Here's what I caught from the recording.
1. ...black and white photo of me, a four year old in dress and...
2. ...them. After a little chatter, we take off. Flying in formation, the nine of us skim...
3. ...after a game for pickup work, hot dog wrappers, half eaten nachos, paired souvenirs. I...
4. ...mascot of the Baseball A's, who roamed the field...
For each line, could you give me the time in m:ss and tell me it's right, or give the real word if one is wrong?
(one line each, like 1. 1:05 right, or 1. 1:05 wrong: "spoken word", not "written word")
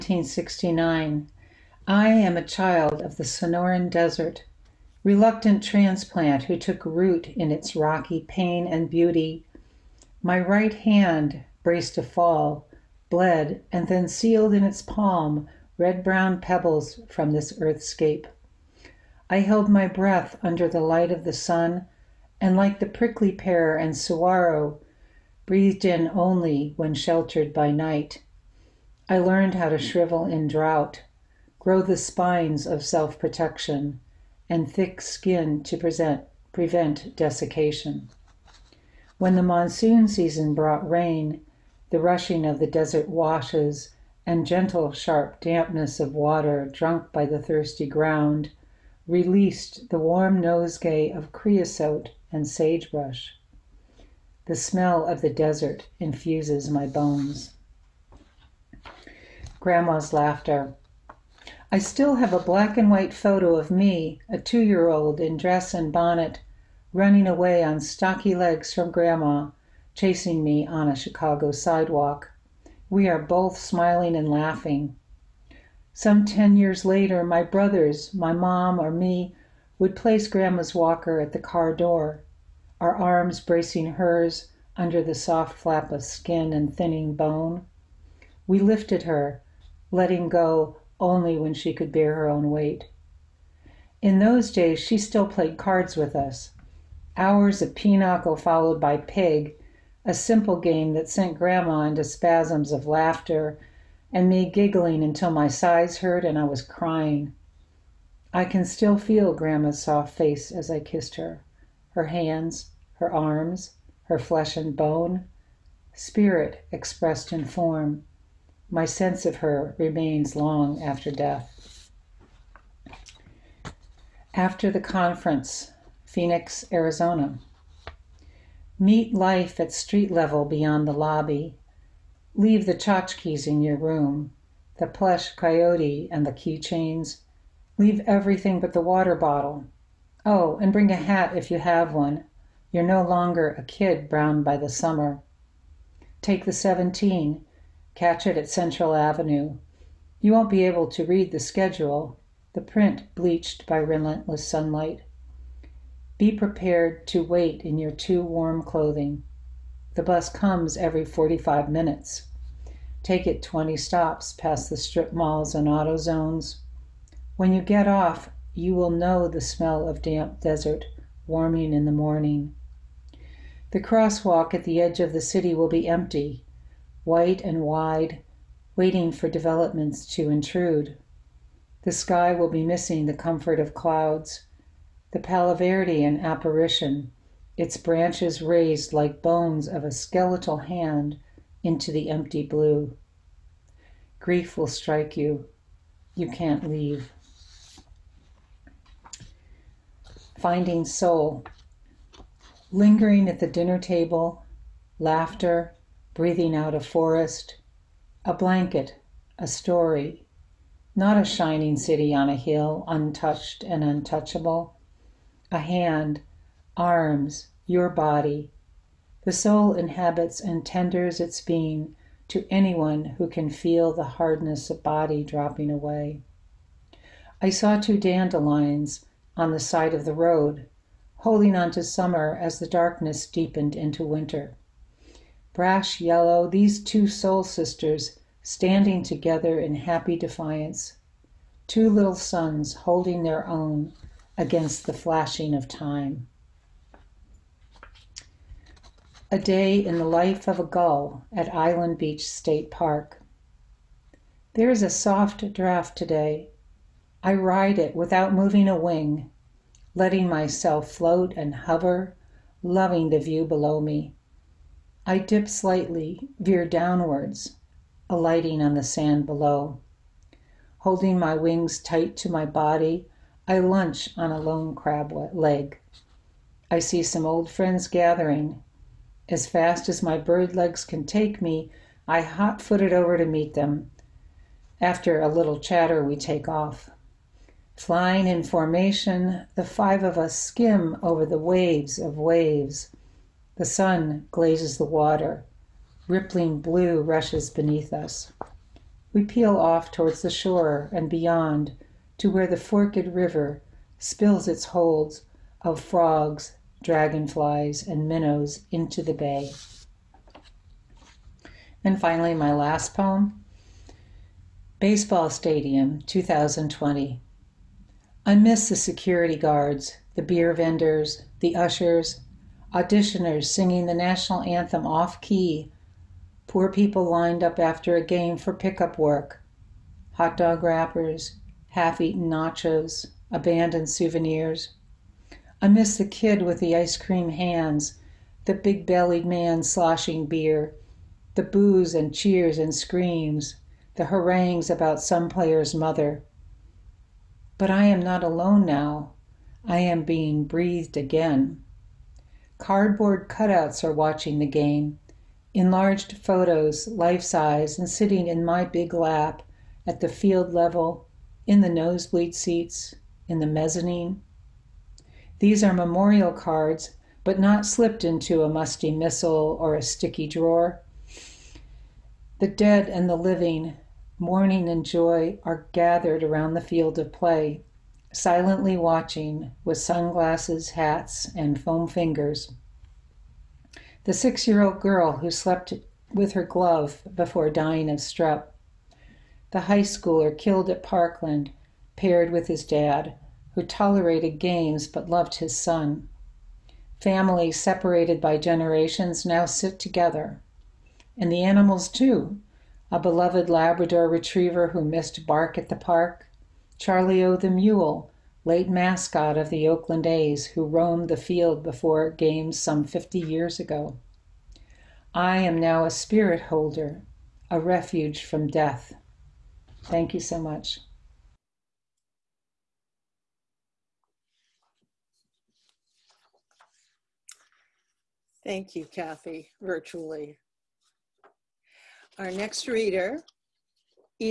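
1. 1:02 wrong: "two", not "four"
2. 4:43 wrong: "five", not "nine"
3. 5:27 wrong: "abandoned", not "paired"
4. 6:48 wrong: "Oakland", not "Baseball".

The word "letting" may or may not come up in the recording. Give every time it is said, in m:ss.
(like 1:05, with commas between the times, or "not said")
1:29, 4:19.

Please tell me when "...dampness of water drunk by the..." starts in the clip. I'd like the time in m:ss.
0:45.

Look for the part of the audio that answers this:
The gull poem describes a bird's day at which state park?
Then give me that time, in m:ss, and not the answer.
4:11.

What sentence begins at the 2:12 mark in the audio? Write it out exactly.
Leave the tchotchkes in your room, the plush coyote and the keychains.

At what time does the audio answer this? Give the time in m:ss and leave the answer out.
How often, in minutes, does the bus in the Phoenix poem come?
2:40.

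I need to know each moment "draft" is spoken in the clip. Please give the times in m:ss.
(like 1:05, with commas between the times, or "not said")
4:15.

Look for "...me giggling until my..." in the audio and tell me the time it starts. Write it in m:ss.
1:44.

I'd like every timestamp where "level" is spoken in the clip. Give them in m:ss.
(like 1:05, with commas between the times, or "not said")
2:10, 6:00.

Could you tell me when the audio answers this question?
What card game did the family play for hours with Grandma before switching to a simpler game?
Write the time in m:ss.
1:37.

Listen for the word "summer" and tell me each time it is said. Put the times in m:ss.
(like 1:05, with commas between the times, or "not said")
2:24, 3:51.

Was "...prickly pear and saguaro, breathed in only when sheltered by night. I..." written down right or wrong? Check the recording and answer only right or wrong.
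right.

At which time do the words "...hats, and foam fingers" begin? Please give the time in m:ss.
6:20.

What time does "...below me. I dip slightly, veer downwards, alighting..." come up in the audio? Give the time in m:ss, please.
4:23.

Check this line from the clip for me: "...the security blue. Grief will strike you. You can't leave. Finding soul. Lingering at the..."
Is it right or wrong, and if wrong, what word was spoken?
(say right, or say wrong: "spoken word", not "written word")
wrong: "empty", not "security".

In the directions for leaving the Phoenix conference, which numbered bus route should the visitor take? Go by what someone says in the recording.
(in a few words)
17.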